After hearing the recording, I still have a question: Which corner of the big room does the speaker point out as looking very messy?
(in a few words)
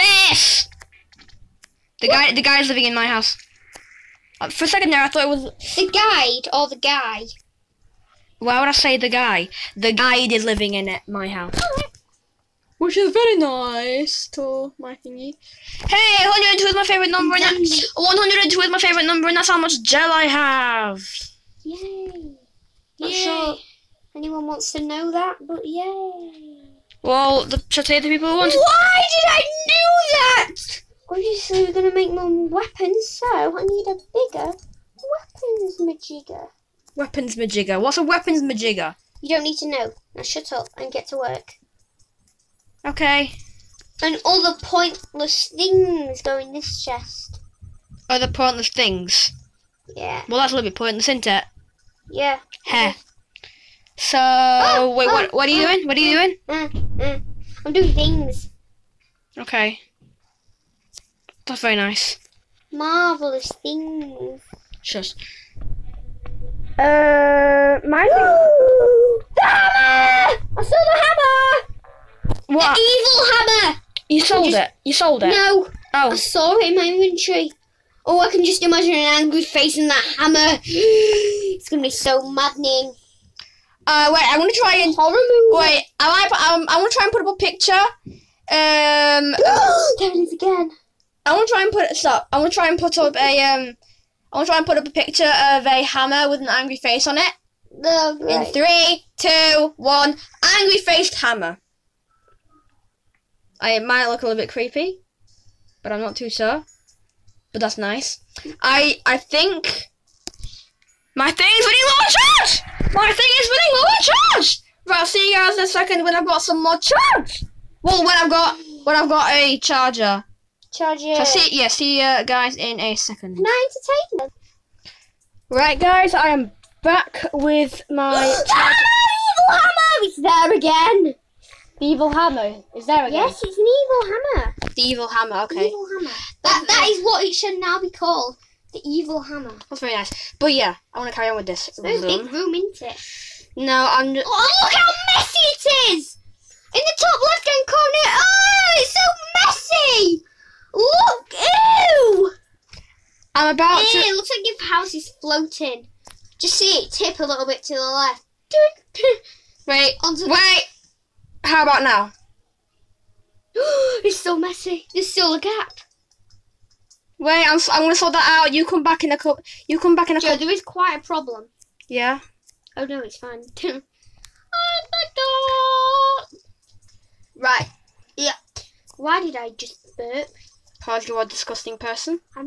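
Top left-hand corner.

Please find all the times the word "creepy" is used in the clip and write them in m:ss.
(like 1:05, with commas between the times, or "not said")
1:44.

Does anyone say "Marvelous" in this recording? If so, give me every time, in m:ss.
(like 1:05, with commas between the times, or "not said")
1:02.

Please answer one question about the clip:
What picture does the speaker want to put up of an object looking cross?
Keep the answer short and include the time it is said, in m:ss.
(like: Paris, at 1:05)
A hammer with an angry face, at 1:35.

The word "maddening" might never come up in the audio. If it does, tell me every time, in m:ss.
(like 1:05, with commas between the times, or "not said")
1:22.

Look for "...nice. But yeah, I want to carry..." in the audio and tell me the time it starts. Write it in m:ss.
2:19.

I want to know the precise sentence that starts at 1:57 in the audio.
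Well, when I've got when I've got a charger.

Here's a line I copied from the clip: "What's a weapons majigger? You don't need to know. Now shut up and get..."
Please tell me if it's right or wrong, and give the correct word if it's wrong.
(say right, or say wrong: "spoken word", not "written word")
right.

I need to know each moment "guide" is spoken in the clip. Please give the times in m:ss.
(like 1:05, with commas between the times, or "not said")
0:05, 0:09.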